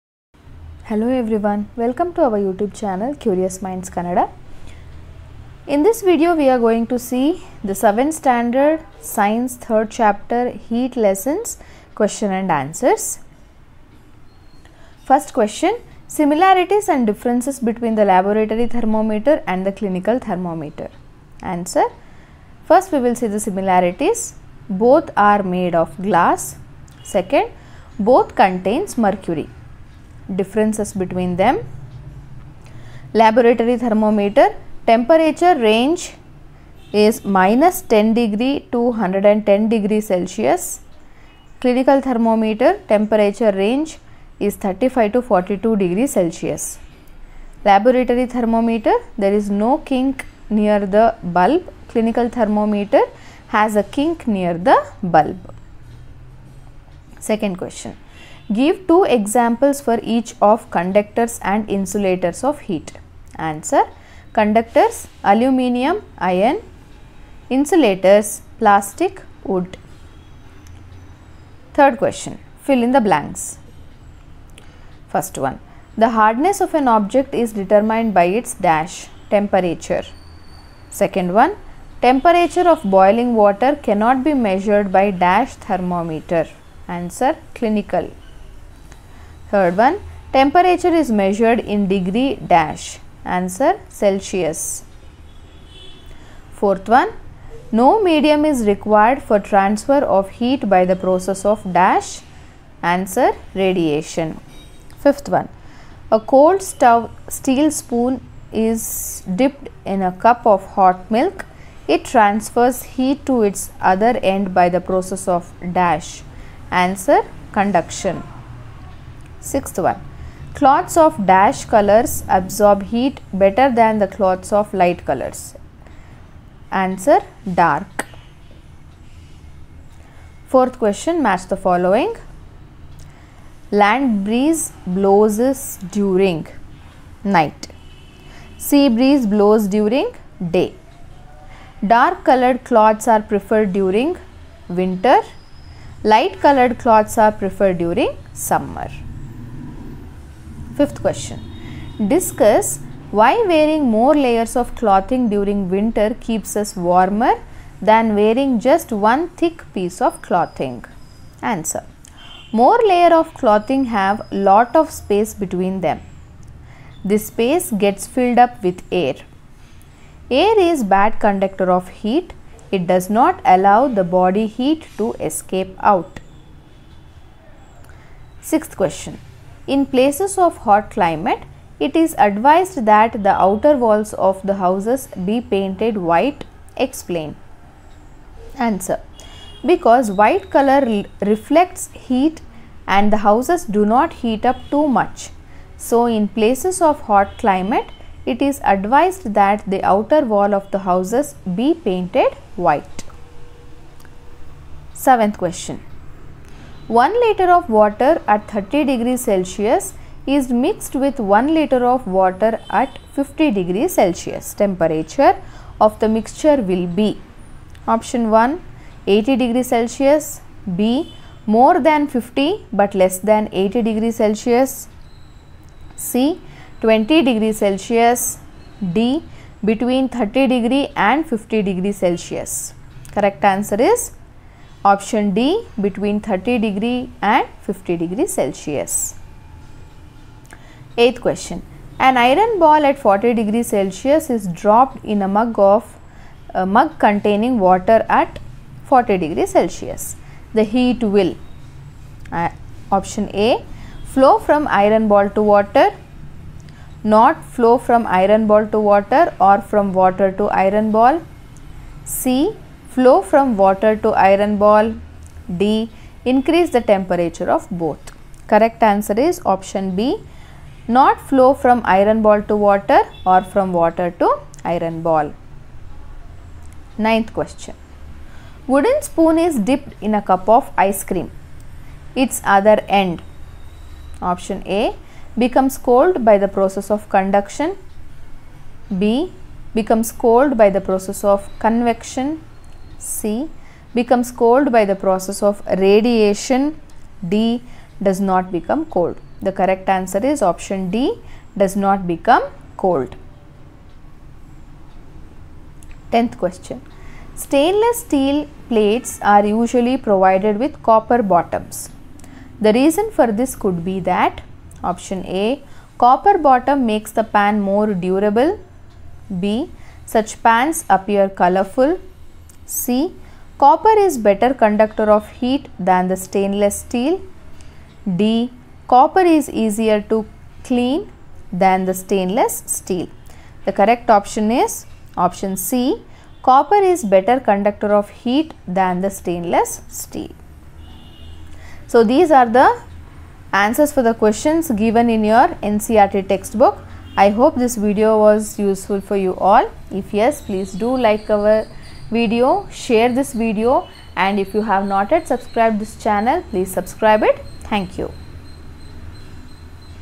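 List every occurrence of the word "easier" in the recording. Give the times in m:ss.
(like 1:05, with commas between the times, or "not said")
5:29.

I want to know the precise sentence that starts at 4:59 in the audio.
The correct answer is option D does not become cold.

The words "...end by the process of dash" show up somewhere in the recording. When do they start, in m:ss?
1:54.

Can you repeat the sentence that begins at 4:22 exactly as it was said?
C flow from water to iron ball.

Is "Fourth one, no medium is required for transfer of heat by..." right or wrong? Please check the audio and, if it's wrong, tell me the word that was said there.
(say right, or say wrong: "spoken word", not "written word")
right.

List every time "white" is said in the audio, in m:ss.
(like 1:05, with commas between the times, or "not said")
3:06, 3:10, 3:22.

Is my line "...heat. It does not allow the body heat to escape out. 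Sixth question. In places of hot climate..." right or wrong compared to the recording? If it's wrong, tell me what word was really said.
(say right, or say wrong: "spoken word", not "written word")
right.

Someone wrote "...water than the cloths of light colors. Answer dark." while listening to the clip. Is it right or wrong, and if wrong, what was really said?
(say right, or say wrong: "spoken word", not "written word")
wrong: "better", not "water".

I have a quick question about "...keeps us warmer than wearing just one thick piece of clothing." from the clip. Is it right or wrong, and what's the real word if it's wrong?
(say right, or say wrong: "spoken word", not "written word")
right.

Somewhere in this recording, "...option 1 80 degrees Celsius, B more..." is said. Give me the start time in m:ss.
3:37.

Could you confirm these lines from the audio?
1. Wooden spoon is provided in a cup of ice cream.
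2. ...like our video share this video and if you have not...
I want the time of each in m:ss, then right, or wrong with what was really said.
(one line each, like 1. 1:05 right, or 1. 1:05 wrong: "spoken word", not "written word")
1. 4:38 wrong: "dipped", not "provided"
2. 5:50 right.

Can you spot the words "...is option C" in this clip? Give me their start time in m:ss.
5:34.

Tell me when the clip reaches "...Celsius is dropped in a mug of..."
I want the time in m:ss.
4:03.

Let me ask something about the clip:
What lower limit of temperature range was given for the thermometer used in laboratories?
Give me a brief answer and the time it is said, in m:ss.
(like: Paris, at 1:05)
-10 degrees Celsius, at 0:37.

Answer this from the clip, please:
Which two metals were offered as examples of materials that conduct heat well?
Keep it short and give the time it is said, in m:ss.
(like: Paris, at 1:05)
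Aluminium, iron, at 1:05.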